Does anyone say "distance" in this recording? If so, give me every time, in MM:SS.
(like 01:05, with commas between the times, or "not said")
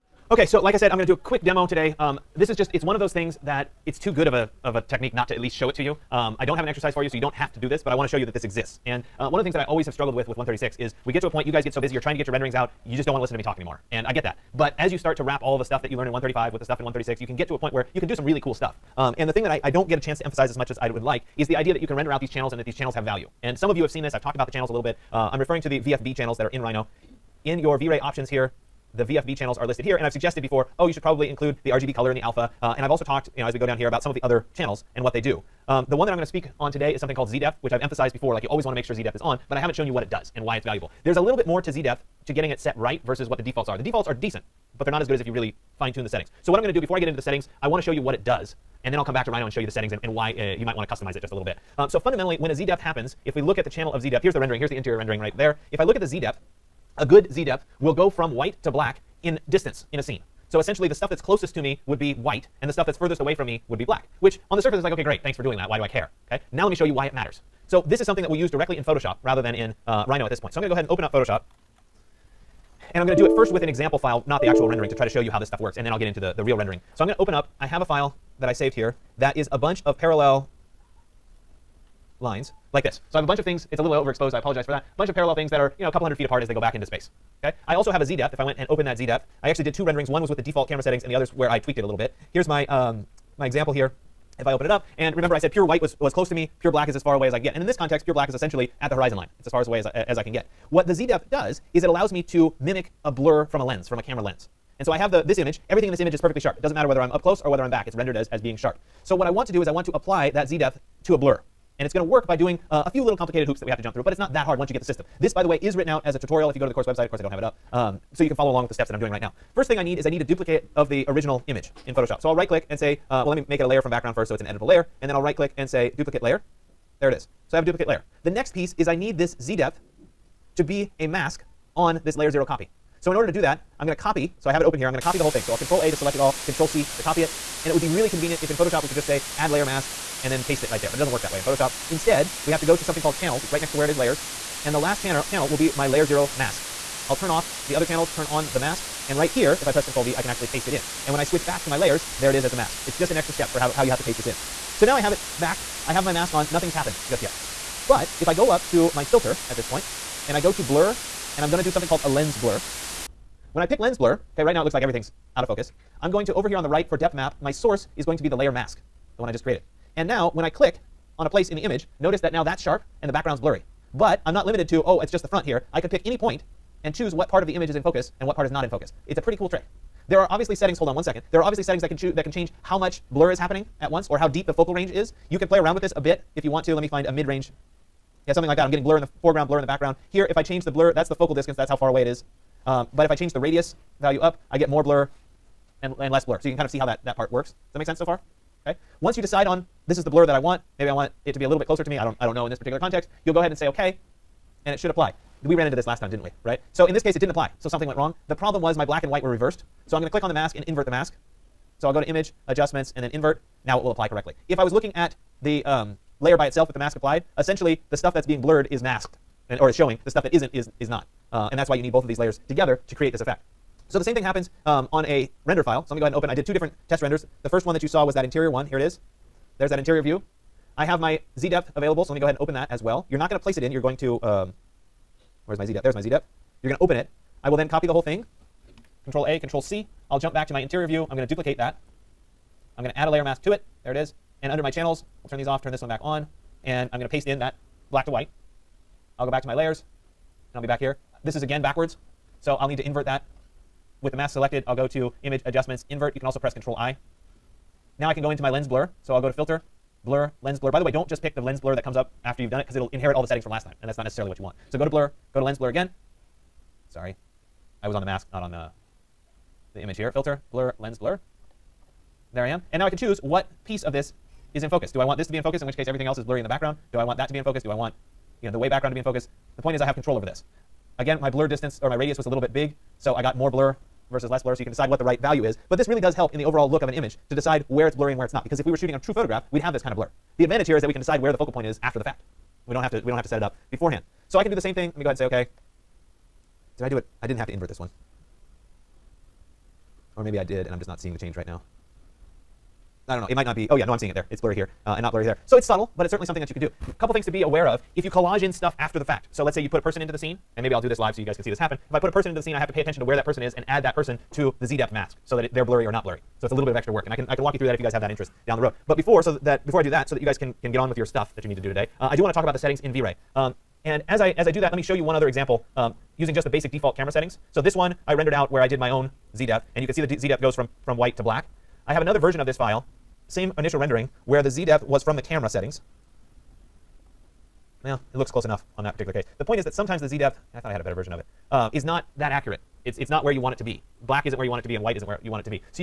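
00:59, 03:11, 04:41.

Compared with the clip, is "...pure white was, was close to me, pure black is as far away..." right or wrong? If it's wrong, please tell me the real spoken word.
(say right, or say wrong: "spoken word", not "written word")
right.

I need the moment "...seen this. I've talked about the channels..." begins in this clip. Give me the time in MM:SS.
00:23.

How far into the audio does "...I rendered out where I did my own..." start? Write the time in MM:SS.
05:28.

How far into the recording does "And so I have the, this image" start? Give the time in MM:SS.
01:44.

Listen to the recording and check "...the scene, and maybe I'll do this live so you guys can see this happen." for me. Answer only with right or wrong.
right.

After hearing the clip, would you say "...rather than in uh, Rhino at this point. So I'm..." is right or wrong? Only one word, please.
right.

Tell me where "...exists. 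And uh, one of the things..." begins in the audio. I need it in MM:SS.
00:08.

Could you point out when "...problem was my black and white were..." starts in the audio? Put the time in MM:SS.
03:28.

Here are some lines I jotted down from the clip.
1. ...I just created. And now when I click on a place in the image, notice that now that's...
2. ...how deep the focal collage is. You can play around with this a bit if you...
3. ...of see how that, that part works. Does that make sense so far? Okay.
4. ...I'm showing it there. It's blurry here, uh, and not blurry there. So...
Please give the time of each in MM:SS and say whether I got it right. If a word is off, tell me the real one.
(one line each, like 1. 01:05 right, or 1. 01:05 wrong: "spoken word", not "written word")
1. 02:49 right
2. 03:04 wrong: "range", not "collage"
3. 03:16 right
4. 05:03 wrong: "seeing", not "showing".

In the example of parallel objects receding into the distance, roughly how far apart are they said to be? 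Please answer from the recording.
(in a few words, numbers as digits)
a couple hundred feet.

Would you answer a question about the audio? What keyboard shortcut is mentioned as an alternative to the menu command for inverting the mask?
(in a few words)
Control I.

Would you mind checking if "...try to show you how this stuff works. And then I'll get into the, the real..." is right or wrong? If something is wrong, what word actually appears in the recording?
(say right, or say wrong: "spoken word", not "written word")
right.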